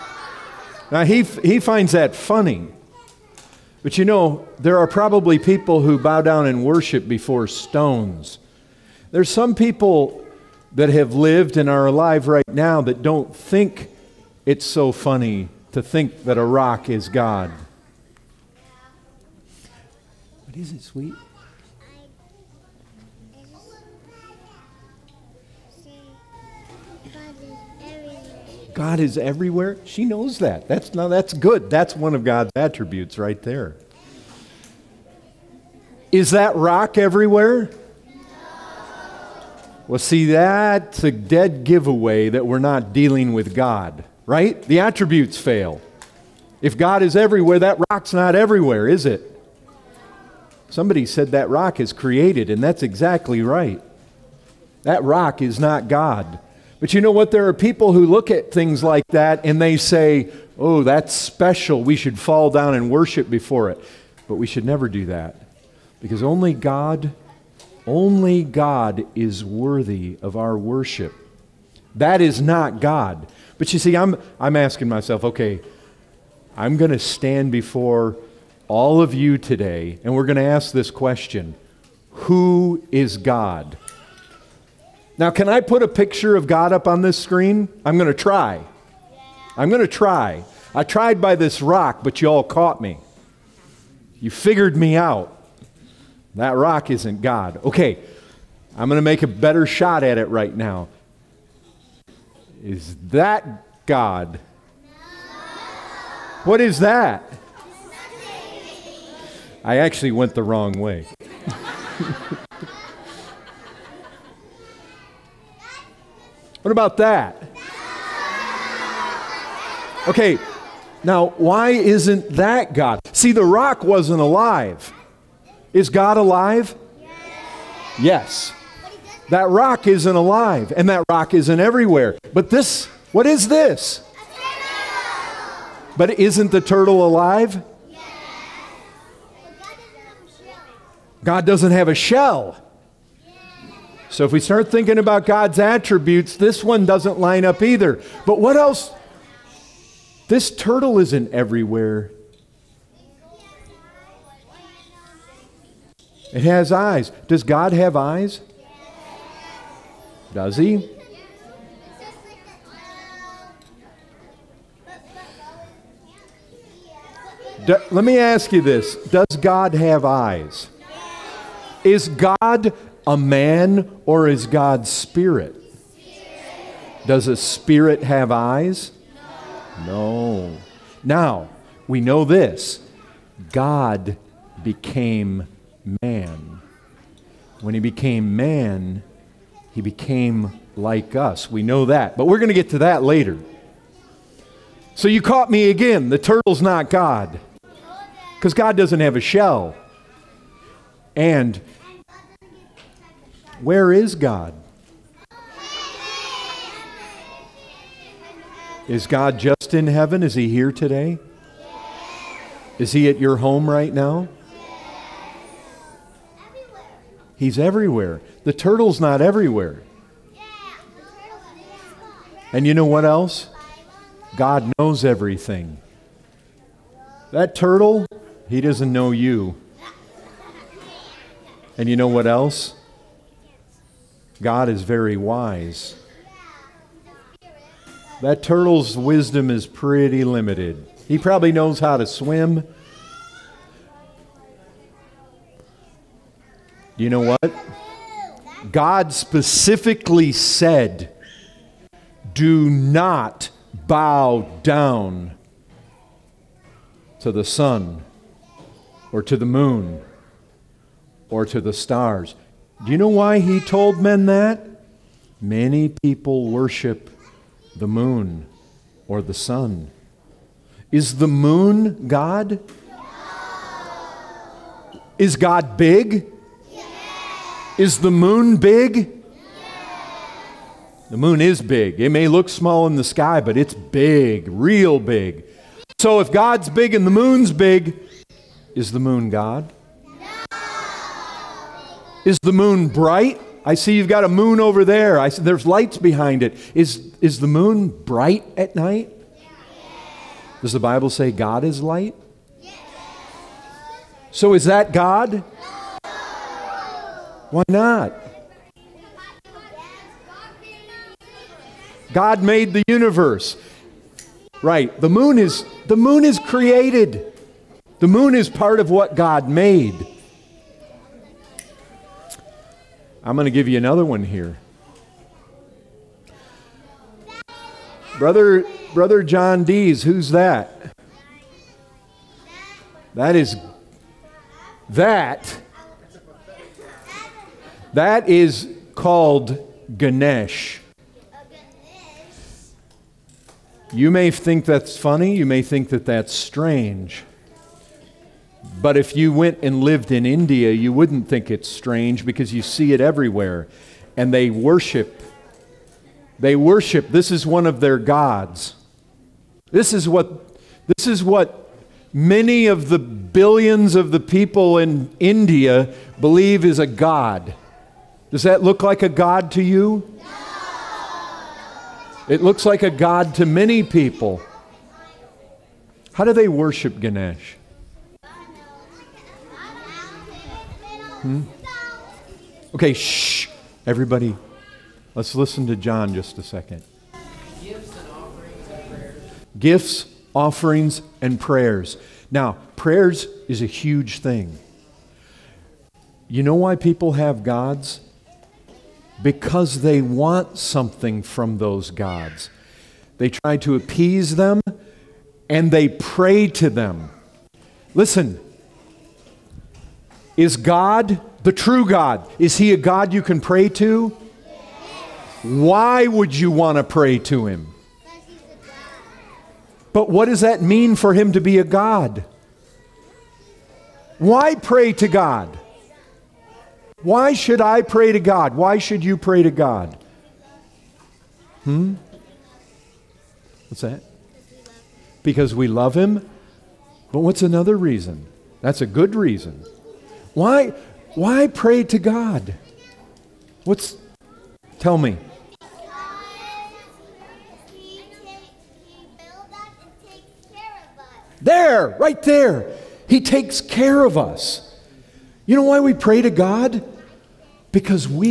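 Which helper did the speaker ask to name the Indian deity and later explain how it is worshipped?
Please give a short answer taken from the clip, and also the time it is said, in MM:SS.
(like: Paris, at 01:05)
Brother John Dees, at 05:28.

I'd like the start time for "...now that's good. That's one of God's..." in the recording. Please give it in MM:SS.
00:30.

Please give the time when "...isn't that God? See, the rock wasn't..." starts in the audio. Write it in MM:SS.
02:01.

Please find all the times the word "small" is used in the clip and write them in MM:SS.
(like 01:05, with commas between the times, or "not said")
04:42.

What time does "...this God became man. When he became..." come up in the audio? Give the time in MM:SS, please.
03:02.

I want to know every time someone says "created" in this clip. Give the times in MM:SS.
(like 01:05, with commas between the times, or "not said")
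00:51, 05:16.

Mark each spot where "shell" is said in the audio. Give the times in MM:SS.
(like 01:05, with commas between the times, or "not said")
02:21, 03:19.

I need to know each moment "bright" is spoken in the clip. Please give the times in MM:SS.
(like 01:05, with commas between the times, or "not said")
04:52, 04:57.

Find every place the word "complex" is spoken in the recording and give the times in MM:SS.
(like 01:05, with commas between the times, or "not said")
not said.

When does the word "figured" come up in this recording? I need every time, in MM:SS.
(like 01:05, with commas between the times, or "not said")
01:34.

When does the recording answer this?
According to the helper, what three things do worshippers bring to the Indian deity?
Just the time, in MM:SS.
06:29.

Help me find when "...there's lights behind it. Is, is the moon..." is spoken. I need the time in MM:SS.
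04:55.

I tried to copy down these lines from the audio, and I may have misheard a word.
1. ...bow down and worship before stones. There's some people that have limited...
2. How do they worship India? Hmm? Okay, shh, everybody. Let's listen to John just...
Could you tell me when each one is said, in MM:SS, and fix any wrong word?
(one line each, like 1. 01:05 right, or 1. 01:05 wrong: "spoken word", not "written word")
1. 00:05 wrong: "lived", not "limited"
2. 06:16 wrong: "Ganesh", not "India".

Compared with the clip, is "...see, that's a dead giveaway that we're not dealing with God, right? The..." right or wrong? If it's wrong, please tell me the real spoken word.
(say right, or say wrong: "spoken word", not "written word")
right.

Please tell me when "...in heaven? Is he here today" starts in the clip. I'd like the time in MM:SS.
03:29.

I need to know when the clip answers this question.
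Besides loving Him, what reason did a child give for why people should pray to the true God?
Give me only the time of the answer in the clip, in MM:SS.
07:33.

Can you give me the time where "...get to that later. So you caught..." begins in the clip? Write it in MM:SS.
03:12.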